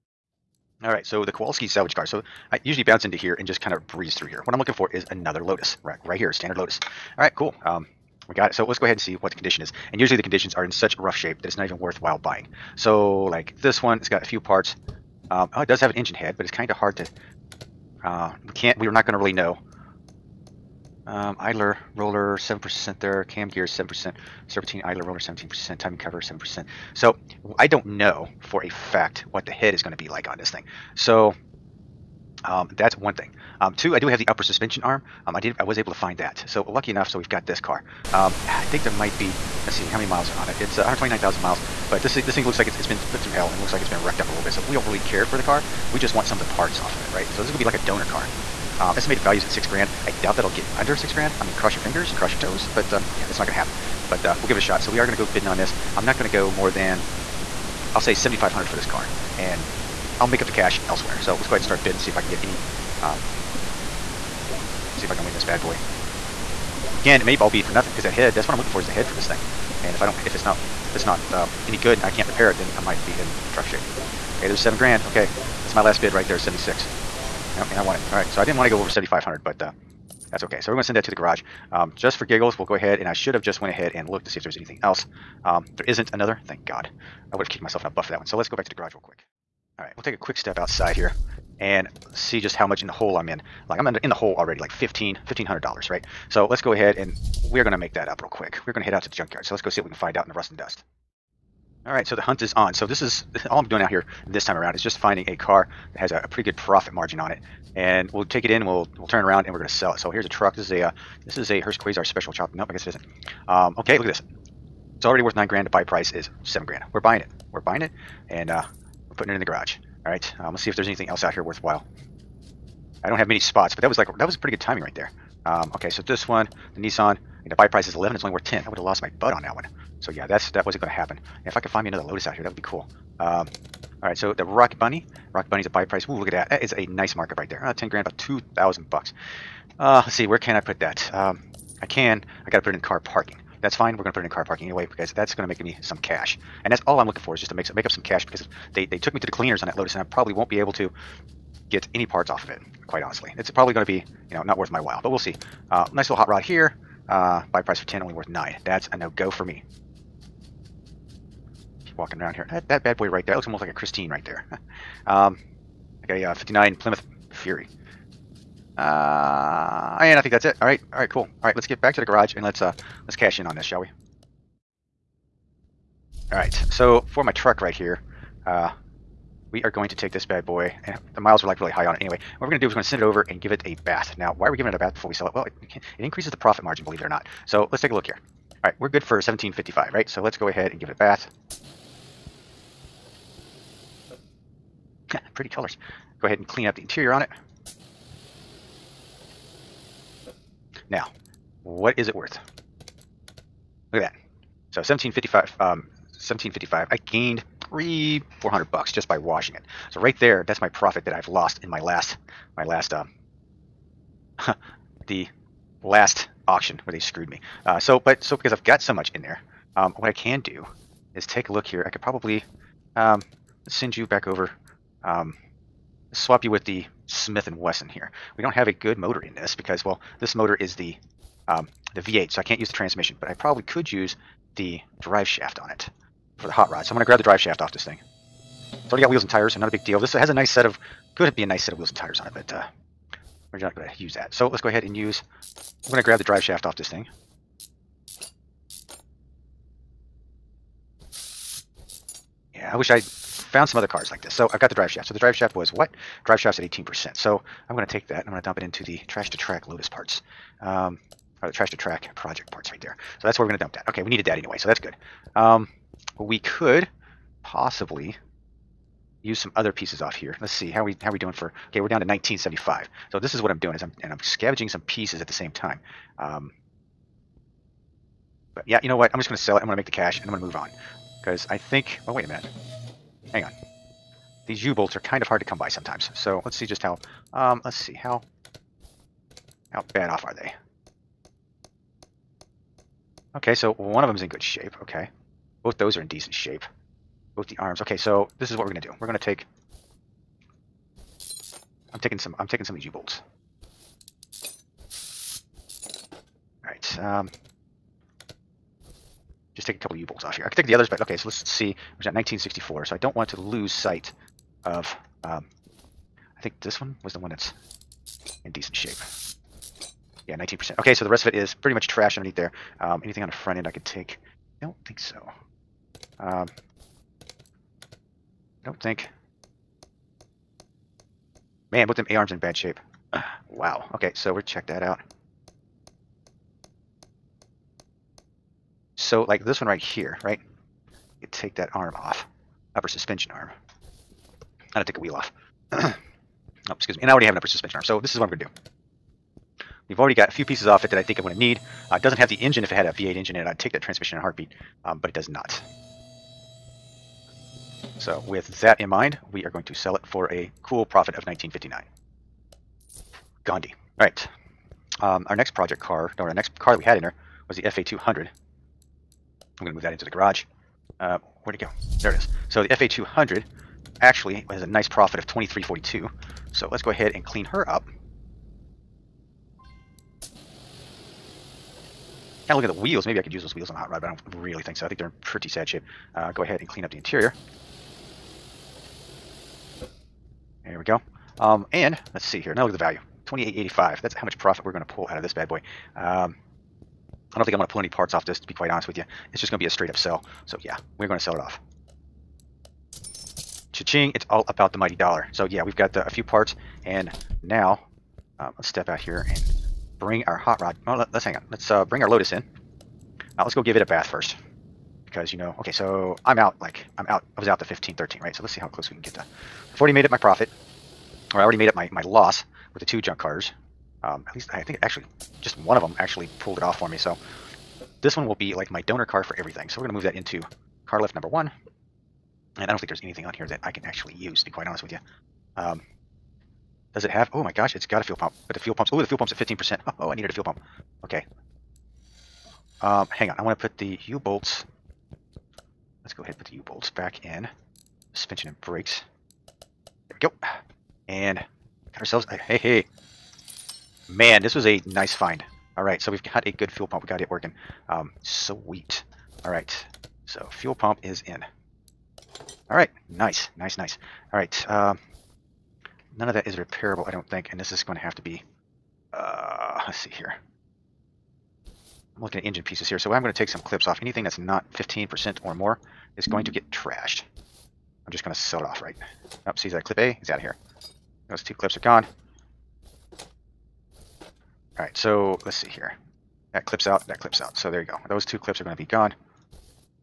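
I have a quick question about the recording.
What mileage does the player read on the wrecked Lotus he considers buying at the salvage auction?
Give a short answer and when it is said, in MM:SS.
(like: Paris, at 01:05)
129,000, at 00:40.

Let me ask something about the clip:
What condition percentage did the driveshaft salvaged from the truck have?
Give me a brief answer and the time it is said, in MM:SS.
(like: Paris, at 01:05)
18%, at 04:16.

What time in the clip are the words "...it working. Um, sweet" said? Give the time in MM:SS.
07:37.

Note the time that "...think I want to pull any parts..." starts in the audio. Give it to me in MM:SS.
06:37.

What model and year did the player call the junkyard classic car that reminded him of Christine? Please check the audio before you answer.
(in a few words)
59 Plymouth Fury.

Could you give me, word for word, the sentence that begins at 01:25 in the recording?
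Um, there isn't another, thank God.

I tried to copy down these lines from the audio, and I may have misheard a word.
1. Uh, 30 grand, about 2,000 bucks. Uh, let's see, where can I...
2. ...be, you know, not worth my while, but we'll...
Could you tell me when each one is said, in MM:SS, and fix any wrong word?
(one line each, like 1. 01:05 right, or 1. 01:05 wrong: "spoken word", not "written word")
1. 02:17 wrong: "10", not "30"
2. 02:33 right.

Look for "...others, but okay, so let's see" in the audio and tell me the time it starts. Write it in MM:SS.
05:10.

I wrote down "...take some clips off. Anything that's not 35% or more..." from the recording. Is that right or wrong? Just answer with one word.
wrong.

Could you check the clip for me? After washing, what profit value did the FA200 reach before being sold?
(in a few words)
2885.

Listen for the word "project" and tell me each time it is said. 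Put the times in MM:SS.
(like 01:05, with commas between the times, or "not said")
04:22, 06:05.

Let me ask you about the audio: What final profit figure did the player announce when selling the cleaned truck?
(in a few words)
1959.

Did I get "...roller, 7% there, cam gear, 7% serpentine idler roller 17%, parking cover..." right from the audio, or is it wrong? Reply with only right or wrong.
wrong.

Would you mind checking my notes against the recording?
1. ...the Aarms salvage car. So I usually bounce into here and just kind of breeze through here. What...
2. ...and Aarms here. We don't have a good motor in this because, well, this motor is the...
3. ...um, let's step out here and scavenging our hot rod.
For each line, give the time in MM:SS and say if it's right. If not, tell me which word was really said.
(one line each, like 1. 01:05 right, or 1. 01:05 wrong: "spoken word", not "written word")
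1. 00:01 wrong: "Kowalski", not "Aarms"
2. 03:47 wrong: "Wesson", not "Aarms"
3. 06:48 wrong: "bring", not "scavenging".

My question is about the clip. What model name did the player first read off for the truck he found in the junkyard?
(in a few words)
Hurst Quayzar Special Chop.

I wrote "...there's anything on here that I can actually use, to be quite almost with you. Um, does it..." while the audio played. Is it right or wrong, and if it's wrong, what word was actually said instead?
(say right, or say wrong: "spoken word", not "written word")
wrong: "honest", not "almost".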